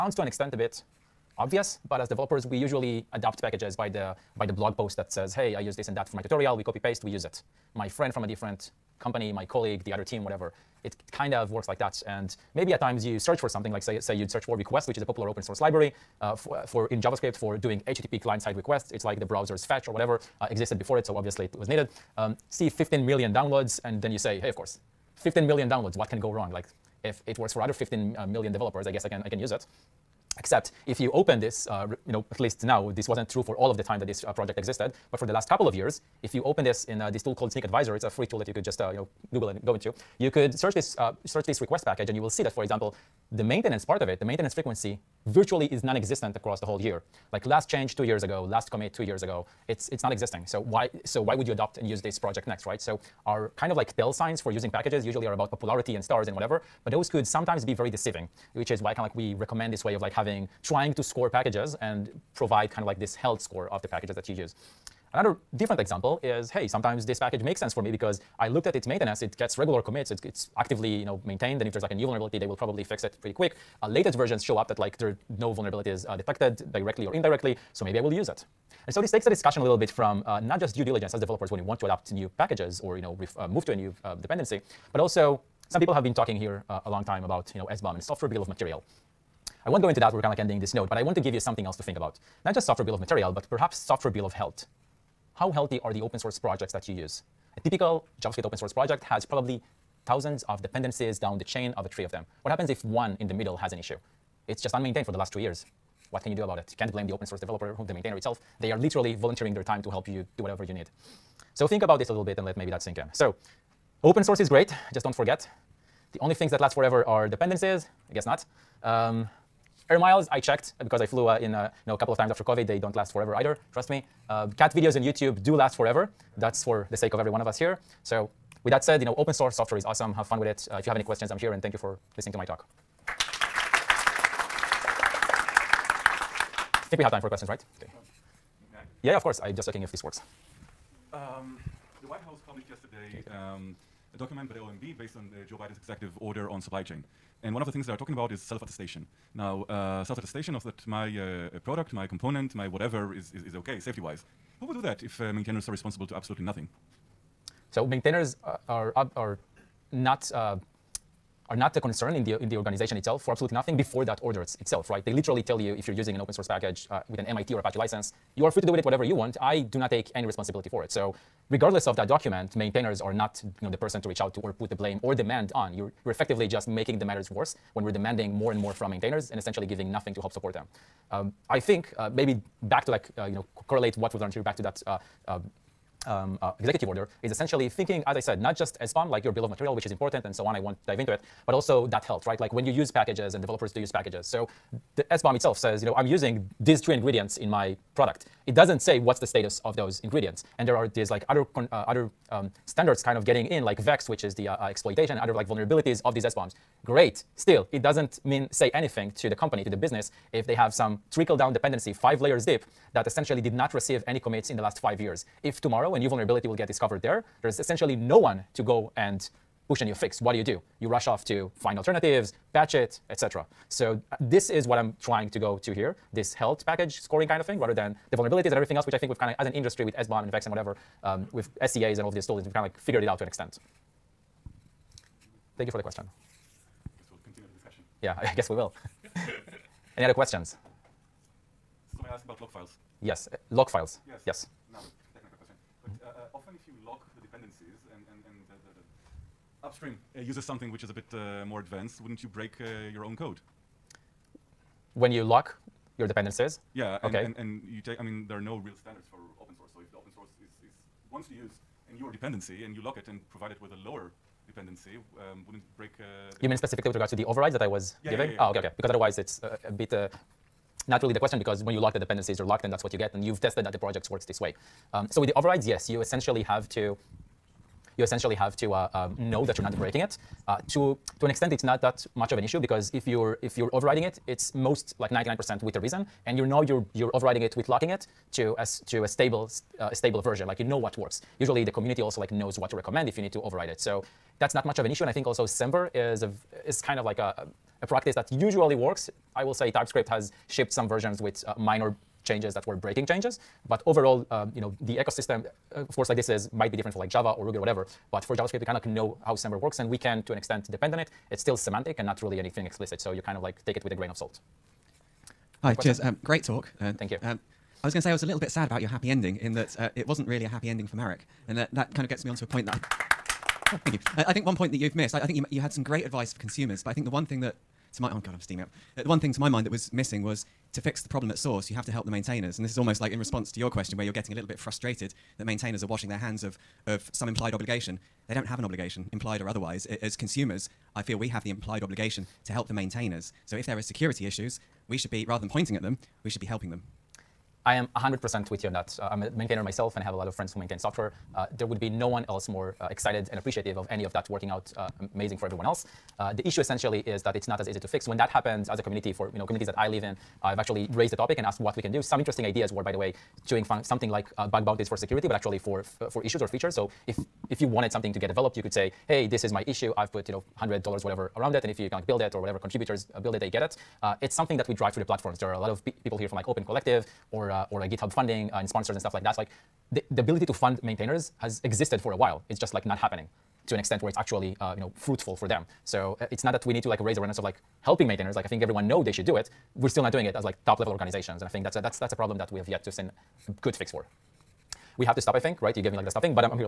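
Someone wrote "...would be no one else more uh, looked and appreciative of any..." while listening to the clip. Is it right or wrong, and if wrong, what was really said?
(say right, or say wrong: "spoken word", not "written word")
wrong: "excited", not "looked".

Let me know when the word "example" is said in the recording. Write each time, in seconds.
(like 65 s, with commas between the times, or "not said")
42 s, 65 s.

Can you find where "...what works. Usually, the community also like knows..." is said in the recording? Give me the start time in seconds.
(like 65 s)
290 s.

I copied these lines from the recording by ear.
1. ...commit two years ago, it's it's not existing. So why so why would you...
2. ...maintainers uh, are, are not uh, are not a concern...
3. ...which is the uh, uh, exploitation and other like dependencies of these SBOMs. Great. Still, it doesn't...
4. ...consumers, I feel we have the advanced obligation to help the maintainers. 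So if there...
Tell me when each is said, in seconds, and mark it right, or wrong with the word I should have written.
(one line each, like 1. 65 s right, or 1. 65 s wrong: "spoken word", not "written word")
1. 48 s right
2. 157 s right
3. 204 s wrong: "vulnerabilities", not "dependencies"
4. 340 s wrong: "implied", not "advanced".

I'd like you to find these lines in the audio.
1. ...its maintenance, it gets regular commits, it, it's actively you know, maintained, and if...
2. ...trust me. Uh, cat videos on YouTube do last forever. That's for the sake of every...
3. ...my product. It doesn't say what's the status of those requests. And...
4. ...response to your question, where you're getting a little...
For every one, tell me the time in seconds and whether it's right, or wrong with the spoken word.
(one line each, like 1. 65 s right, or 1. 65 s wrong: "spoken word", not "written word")
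1. 68 s right
2. 123 s right
3. 197 s wrong: "ingredients", not "requests"
4. 333 s right.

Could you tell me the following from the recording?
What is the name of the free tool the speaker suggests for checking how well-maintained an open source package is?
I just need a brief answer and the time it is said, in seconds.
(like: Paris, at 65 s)
Snyk Advisor, at 37 s.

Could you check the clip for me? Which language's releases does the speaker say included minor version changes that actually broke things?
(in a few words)
TypeScript.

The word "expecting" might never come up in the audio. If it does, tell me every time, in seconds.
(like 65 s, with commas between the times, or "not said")
not said.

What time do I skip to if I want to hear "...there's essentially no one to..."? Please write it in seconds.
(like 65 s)
217 s.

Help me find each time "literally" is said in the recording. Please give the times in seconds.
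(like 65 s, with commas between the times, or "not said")
108 s, 165 s.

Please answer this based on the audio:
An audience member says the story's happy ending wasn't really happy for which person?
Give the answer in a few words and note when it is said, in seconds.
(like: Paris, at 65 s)
Marak, at 320 s.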